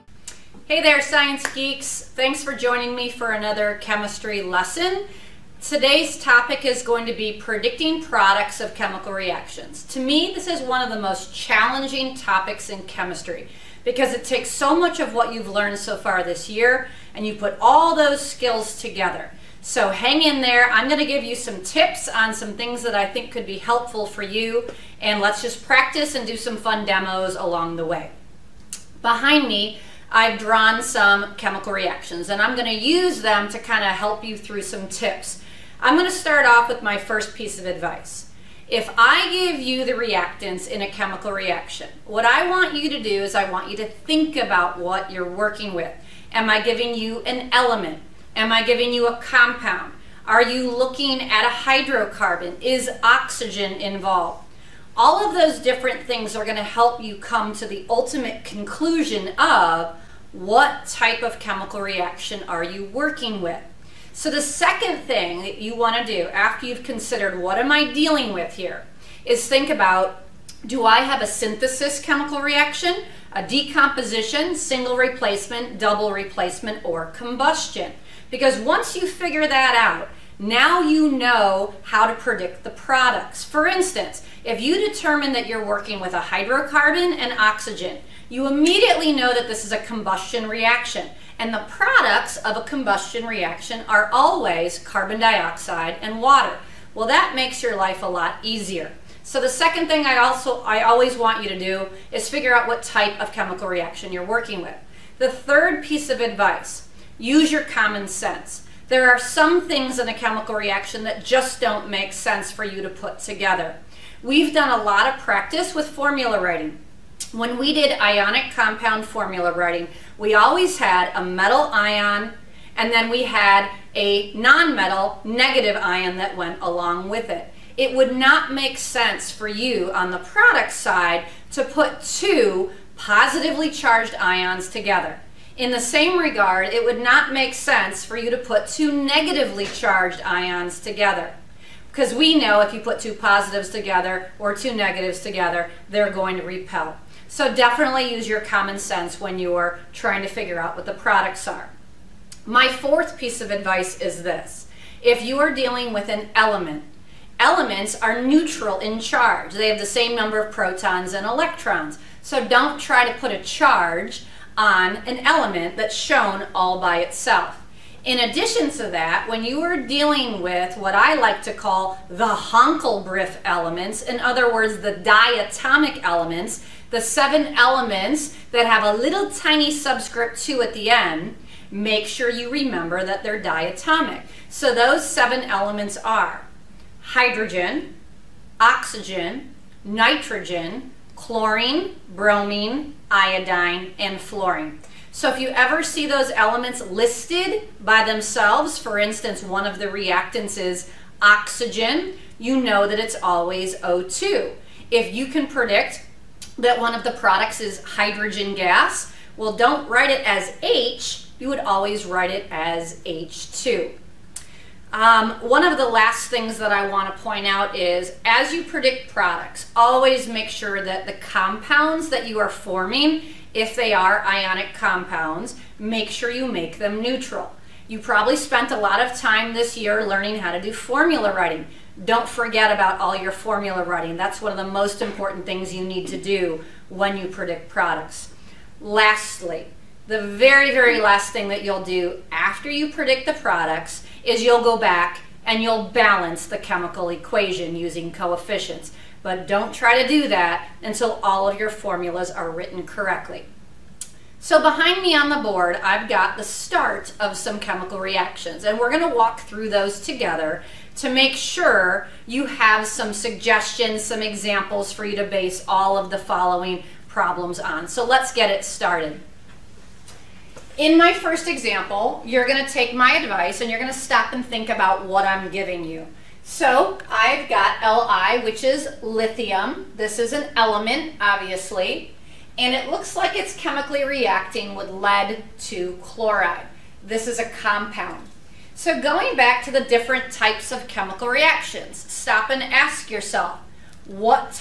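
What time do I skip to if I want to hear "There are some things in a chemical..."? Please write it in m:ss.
1:48.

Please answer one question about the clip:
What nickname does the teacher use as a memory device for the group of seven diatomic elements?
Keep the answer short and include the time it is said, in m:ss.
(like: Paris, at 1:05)
HONClBrIF, at 2:52.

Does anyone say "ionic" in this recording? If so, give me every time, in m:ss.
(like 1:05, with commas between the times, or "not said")
1:57, 3:44.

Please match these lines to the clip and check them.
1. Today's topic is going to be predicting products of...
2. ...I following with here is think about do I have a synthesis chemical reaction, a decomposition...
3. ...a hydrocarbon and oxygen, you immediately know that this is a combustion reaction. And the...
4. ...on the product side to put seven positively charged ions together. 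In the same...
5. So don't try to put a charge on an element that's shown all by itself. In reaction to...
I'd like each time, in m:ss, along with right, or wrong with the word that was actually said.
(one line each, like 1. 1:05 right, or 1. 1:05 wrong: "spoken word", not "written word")
1. 0:05 right
2. 1:07 wrong: "dealing", not "following"
3. 1:26 right
4. 2:09 wrong: "two", not "seven"
5. 2:42 wrong: "addition", not "reaction".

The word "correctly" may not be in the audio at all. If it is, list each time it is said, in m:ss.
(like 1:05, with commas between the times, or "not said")
4:12.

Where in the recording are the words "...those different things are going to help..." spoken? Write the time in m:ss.
0:55.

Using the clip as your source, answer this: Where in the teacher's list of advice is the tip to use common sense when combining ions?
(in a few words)
third.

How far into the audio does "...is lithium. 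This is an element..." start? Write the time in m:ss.
4:38.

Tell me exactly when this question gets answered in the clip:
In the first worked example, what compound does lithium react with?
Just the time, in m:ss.
4:44.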